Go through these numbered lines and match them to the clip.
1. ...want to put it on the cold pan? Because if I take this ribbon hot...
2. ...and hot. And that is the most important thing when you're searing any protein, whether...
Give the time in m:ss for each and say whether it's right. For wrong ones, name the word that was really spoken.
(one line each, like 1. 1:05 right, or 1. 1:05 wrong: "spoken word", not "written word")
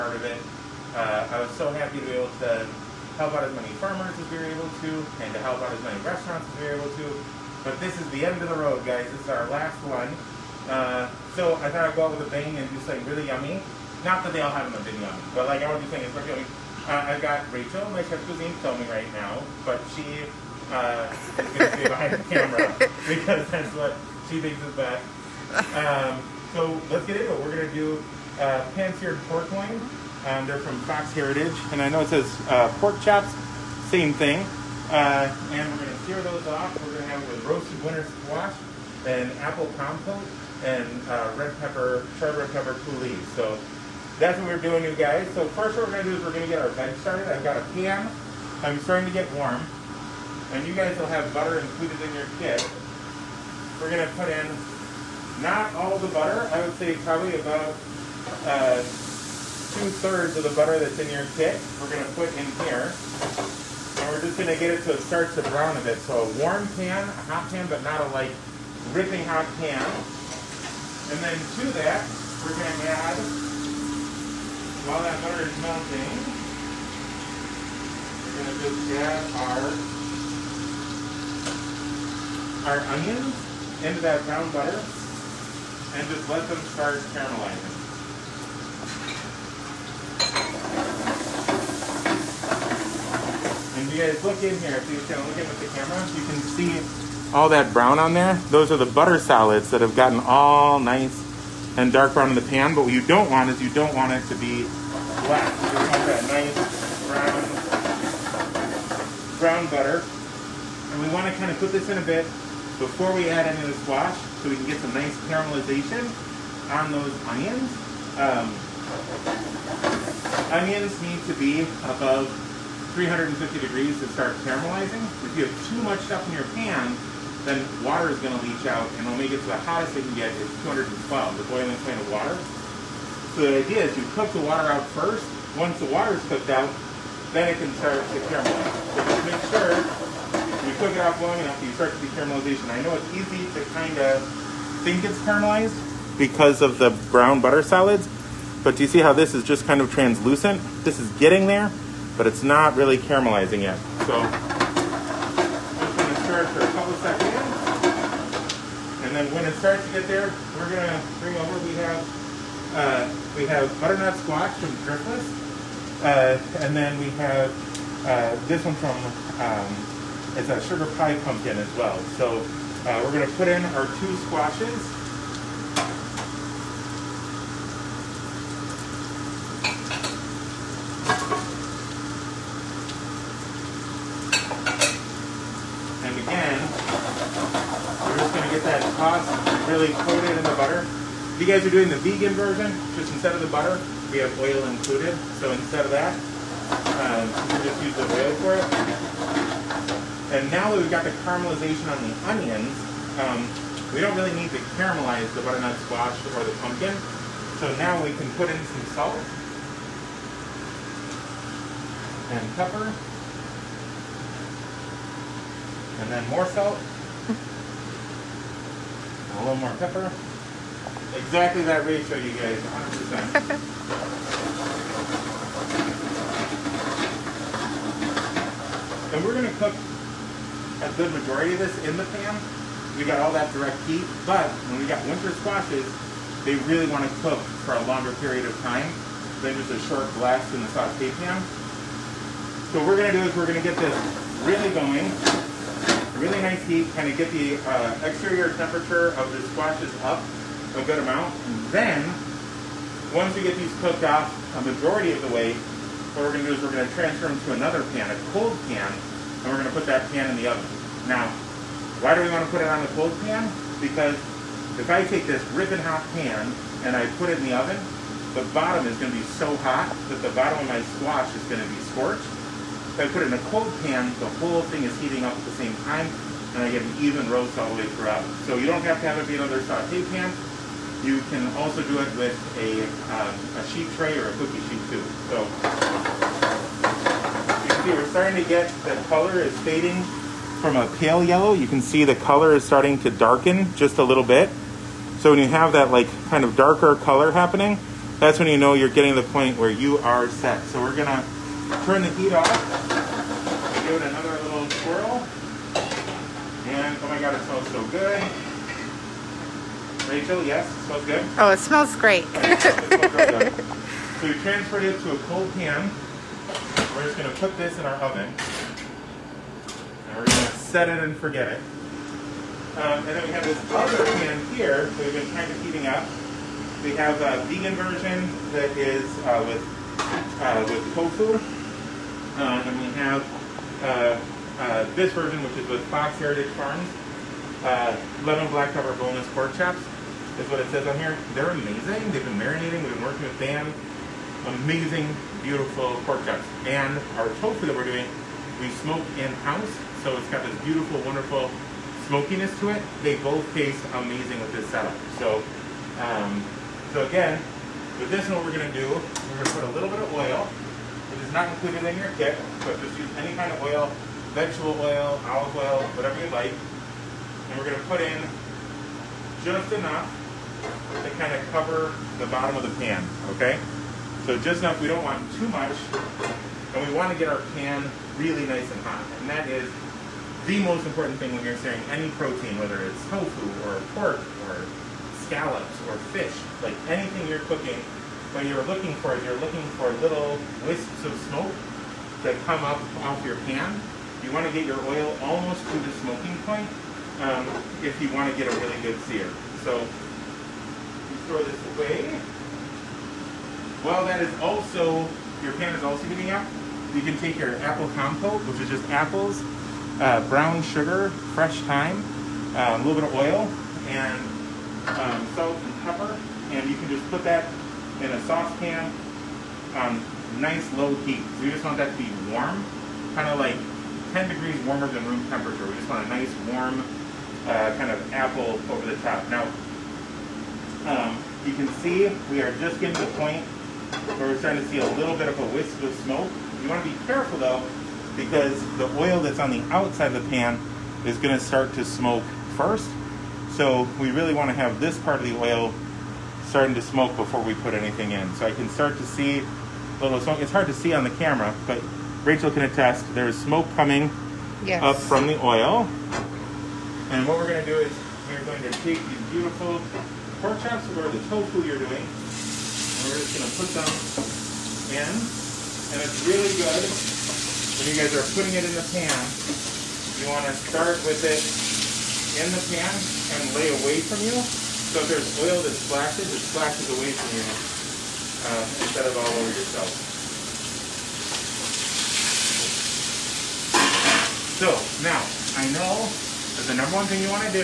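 1. 4:22 right
2. 6:18 right.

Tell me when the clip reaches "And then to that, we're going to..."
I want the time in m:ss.
1:11.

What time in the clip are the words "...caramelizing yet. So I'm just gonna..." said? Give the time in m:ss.
2:32.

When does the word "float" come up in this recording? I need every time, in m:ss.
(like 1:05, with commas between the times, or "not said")
not said.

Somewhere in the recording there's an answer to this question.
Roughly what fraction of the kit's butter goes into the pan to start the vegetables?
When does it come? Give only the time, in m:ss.
0:59.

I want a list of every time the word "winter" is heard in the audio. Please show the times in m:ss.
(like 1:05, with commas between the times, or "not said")
0:37, 3:55.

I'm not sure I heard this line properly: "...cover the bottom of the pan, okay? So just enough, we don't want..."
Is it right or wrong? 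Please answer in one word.
right.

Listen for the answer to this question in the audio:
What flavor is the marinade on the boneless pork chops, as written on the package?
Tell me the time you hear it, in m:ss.
5:38.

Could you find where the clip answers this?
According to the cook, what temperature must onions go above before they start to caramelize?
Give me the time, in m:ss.
2:02.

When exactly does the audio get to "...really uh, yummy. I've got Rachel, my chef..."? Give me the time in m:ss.
0:16.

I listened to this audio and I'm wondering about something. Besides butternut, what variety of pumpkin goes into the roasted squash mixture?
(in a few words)
sugar pie pumpkin.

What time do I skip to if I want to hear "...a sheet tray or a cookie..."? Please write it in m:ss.
4:43.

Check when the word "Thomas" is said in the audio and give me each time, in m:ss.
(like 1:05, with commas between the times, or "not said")
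not said.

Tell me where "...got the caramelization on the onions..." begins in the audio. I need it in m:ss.
3:20.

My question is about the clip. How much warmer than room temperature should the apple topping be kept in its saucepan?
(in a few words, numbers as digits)
10 degrees.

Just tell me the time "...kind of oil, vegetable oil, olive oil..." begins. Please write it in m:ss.
6:03.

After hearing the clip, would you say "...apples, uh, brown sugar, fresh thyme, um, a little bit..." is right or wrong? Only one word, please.
right.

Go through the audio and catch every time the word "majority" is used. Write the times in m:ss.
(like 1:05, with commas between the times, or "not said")
3:51, 4:14.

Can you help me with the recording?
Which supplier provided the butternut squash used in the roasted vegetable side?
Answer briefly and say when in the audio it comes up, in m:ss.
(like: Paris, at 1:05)
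Driftless, at 2:44.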